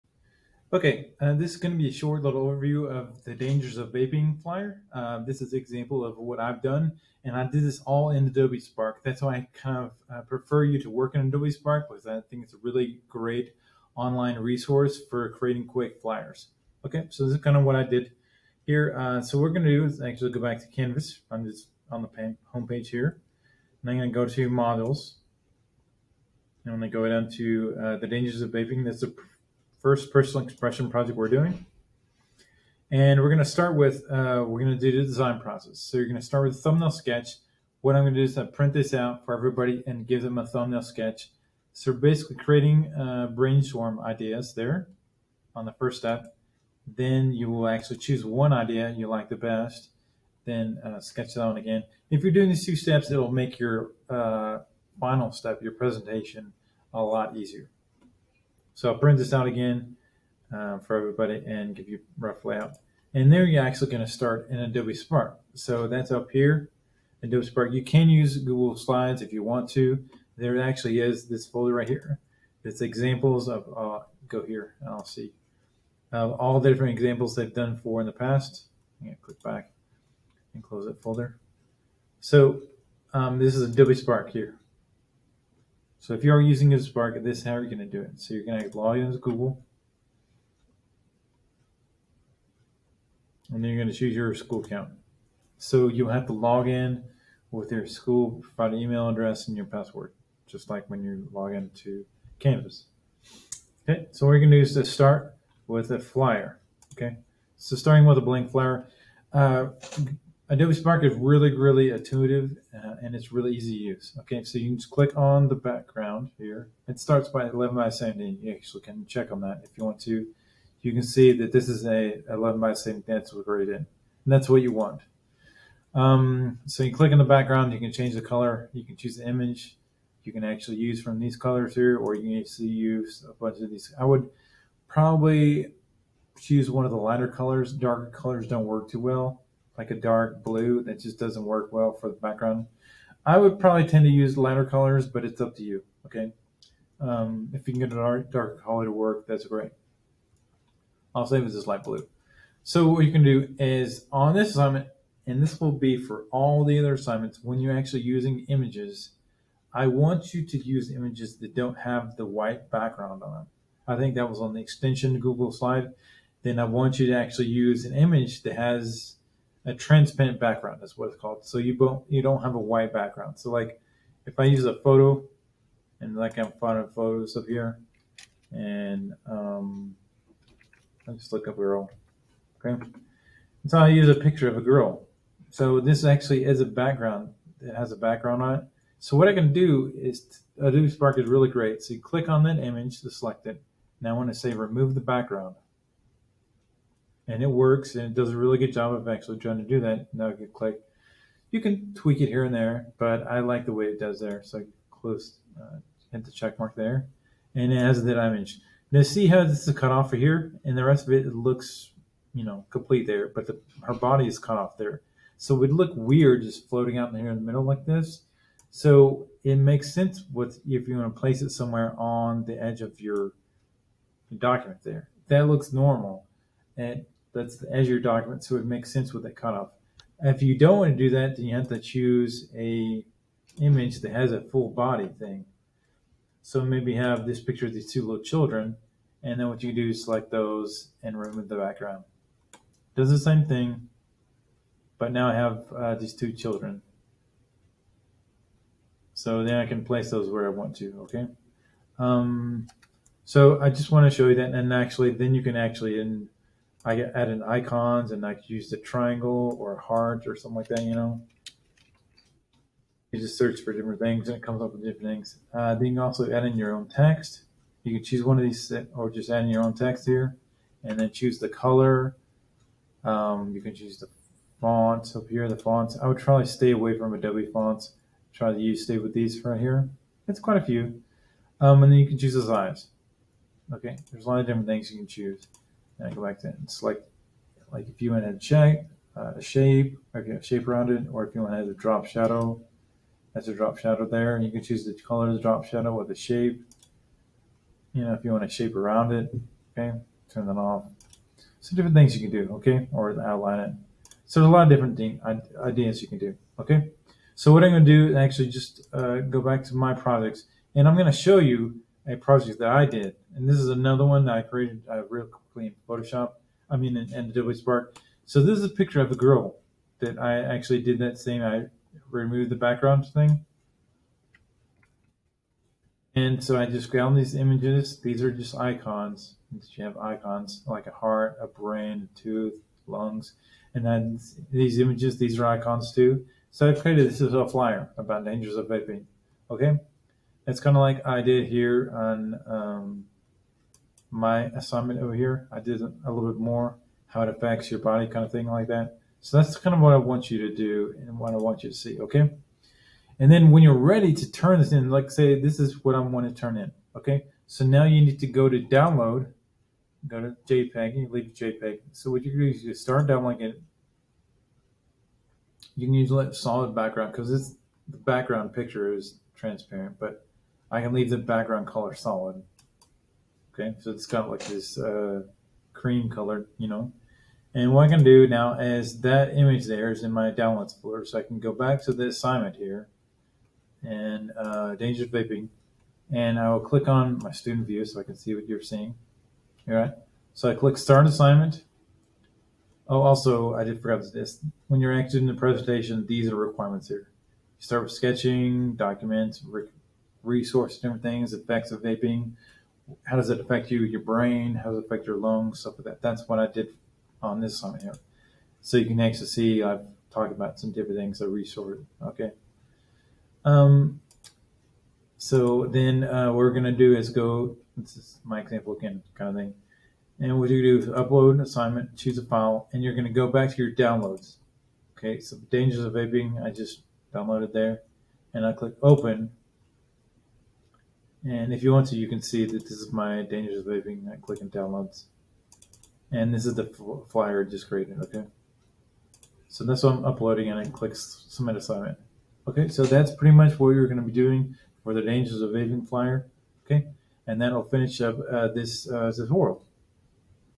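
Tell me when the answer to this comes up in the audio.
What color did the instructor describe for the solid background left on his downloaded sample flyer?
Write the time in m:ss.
6:15.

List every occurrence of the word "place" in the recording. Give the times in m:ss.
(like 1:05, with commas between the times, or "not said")
3:41, 4:09.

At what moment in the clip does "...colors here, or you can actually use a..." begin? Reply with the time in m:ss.
2:11.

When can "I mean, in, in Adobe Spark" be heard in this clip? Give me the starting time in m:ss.
5:16.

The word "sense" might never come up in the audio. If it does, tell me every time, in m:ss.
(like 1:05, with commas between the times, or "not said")
3:39, 3:48.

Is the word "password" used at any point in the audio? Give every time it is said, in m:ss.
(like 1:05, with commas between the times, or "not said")
1:39.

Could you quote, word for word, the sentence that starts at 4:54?
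And you can choose the color of the drop shadow or the shape.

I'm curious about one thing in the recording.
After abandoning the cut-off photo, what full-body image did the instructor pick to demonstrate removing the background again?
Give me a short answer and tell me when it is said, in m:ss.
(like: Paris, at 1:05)
two little children, at 3:57.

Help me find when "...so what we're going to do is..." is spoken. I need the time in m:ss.
0:19.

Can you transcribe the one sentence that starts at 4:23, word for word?
You just search for different things and it comes up with different things.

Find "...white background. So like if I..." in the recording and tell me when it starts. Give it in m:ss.
2:52.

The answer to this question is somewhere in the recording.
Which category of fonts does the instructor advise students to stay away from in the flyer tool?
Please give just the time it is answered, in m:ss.
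4:37.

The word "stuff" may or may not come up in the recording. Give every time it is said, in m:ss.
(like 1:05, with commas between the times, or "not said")
6:45.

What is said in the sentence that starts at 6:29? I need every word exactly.
All right, so I click start assignment.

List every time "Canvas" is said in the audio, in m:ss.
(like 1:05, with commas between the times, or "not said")
0:20, 1:42.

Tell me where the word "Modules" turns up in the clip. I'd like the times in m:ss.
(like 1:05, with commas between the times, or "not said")
0:24.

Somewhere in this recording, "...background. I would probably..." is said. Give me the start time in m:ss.
2:22.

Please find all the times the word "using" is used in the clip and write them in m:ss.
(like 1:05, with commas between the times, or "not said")
1:26, 2:38.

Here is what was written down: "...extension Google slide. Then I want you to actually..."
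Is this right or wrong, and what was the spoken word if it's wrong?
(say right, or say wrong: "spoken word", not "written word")
right.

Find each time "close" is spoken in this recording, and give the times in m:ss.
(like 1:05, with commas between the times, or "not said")
1:20, 3:24.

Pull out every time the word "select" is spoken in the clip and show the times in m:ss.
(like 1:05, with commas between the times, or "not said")
3:13, 4:00, 4:46.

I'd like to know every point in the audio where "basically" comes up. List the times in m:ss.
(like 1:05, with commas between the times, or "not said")
0:41.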